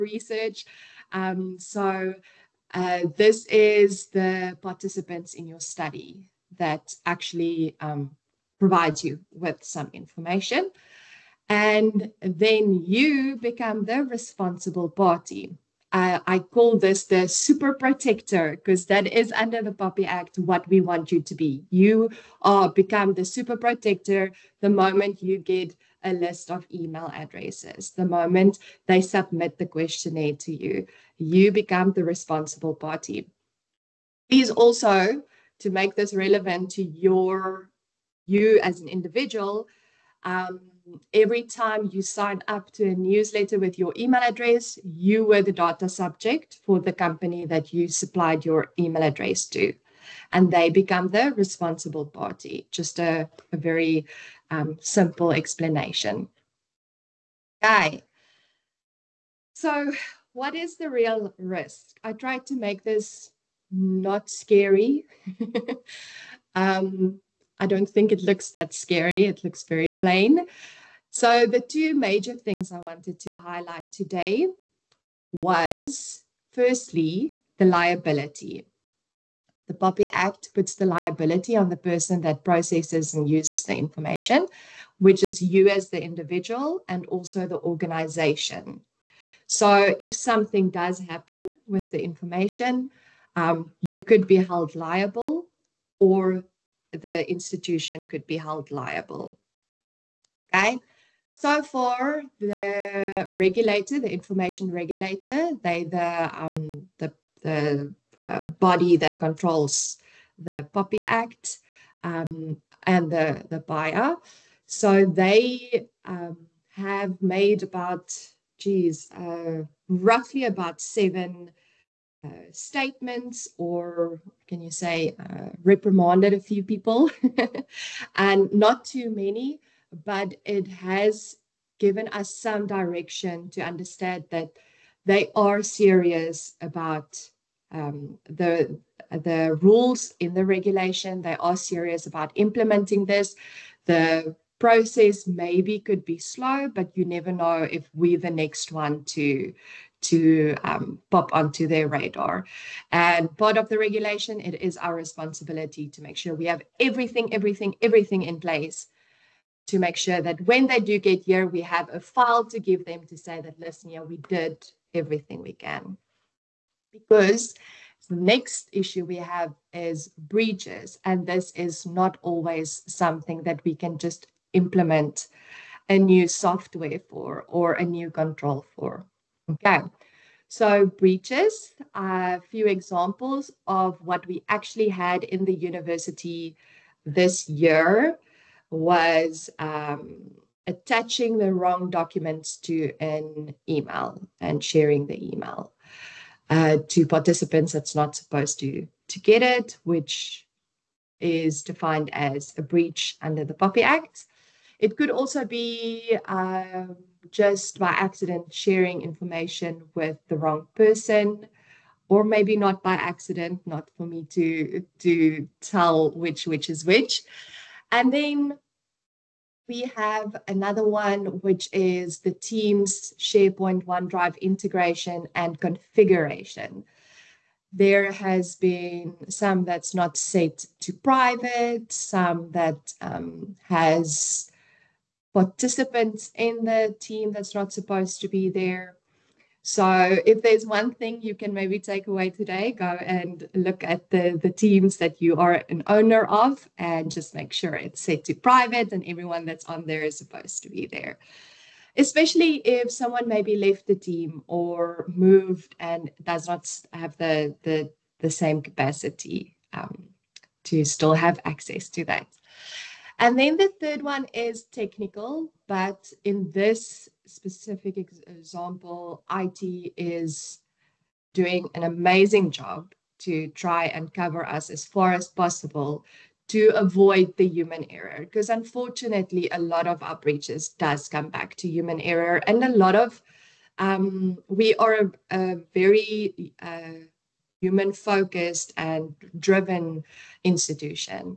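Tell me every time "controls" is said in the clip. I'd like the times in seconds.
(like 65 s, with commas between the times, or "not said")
109 s, 178 s.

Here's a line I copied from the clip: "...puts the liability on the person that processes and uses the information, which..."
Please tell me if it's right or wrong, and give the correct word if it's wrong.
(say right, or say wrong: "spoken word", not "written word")
right.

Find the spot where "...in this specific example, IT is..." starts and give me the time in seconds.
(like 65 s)
266 s.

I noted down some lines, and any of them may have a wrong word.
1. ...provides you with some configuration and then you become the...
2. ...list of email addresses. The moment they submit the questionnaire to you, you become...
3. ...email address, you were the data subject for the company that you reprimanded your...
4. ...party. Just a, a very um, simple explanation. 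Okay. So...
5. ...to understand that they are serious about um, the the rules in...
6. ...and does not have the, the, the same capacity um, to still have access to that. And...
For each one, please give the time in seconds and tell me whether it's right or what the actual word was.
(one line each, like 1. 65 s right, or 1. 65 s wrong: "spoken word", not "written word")
1. 8 s wrong: "information", not "configuration"
2. 26 s right
3. 43 s wrong: "supplied", not "reprimanded"
4. 52 s right
5. 133 s right
6. 255 s right.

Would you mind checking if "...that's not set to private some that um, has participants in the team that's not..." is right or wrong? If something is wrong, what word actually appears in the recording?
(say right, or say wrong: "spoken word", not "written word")
right.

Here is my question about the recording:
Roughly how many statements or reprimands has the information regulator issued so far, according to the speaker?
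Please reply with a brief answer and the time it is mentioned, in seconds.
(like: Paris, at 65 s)
7, at 120 s.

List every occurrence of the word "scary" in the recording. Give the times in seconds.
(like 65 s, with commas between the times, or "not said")
64 s, 68 s.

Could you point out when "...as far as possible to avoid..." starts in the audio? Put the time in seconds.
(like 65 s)
274 s.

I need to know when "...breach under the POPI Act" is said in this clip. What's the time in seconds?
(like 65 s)
202 s.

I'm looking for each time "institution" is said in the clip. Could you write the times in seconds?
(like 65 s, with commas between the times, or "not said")
97 s, 290 s.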